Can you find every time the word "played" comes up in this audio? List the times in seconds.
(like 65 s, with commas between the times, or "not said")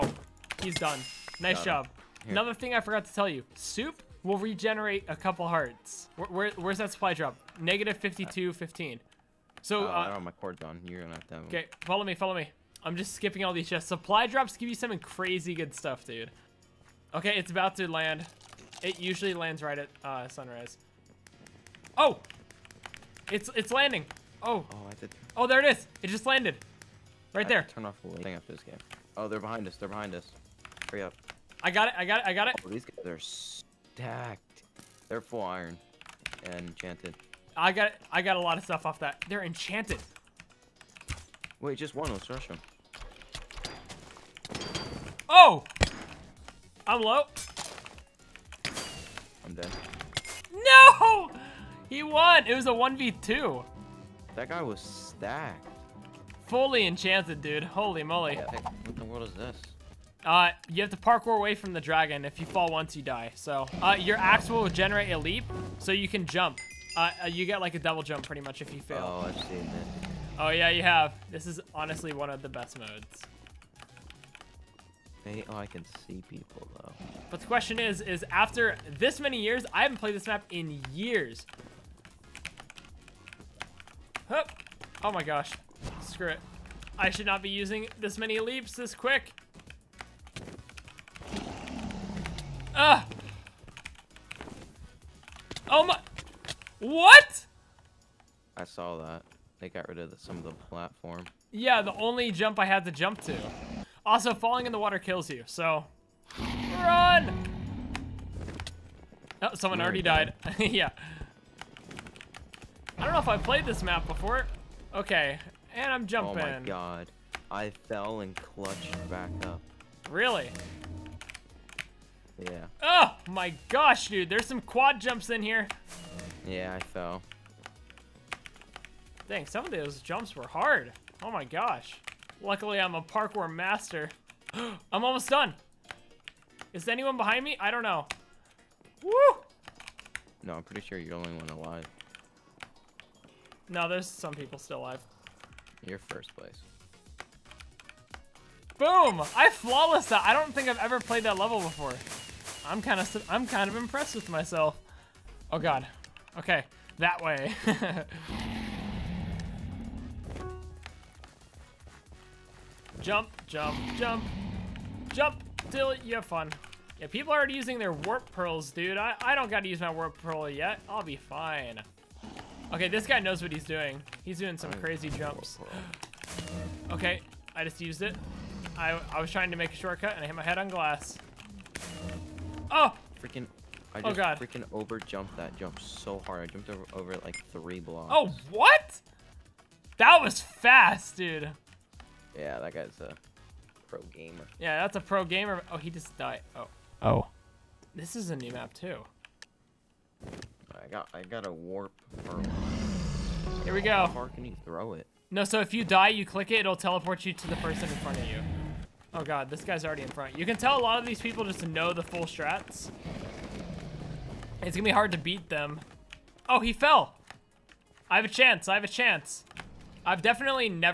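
79 s, 113 s, 150 s.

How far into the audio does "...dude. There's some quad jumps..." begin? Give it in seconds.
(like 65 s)
124 s.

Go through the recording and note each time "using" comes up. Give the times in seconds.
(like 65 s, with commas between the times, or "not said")
87 s, 167 s.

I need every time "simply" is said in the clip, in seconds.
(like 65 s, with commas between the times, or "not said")
not said.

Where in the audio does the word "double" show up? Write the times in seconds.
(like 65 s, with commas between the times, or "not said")
67 s.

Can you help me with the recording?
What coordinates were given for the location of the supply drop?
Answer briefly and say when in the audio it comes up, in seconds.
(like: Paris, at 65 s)
-52, 15, at 7 s.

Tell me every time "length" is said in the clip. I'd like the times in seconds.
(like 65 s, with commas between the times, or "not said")
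not said.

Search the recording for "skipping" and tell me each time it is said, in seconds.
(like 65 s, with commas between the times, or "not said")
13 s.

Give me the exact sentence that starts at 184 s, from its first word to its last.
freaking over jumped that jump so hard.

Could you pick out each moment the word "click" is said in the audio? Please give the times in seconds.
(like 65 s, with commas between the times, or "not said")
206 s.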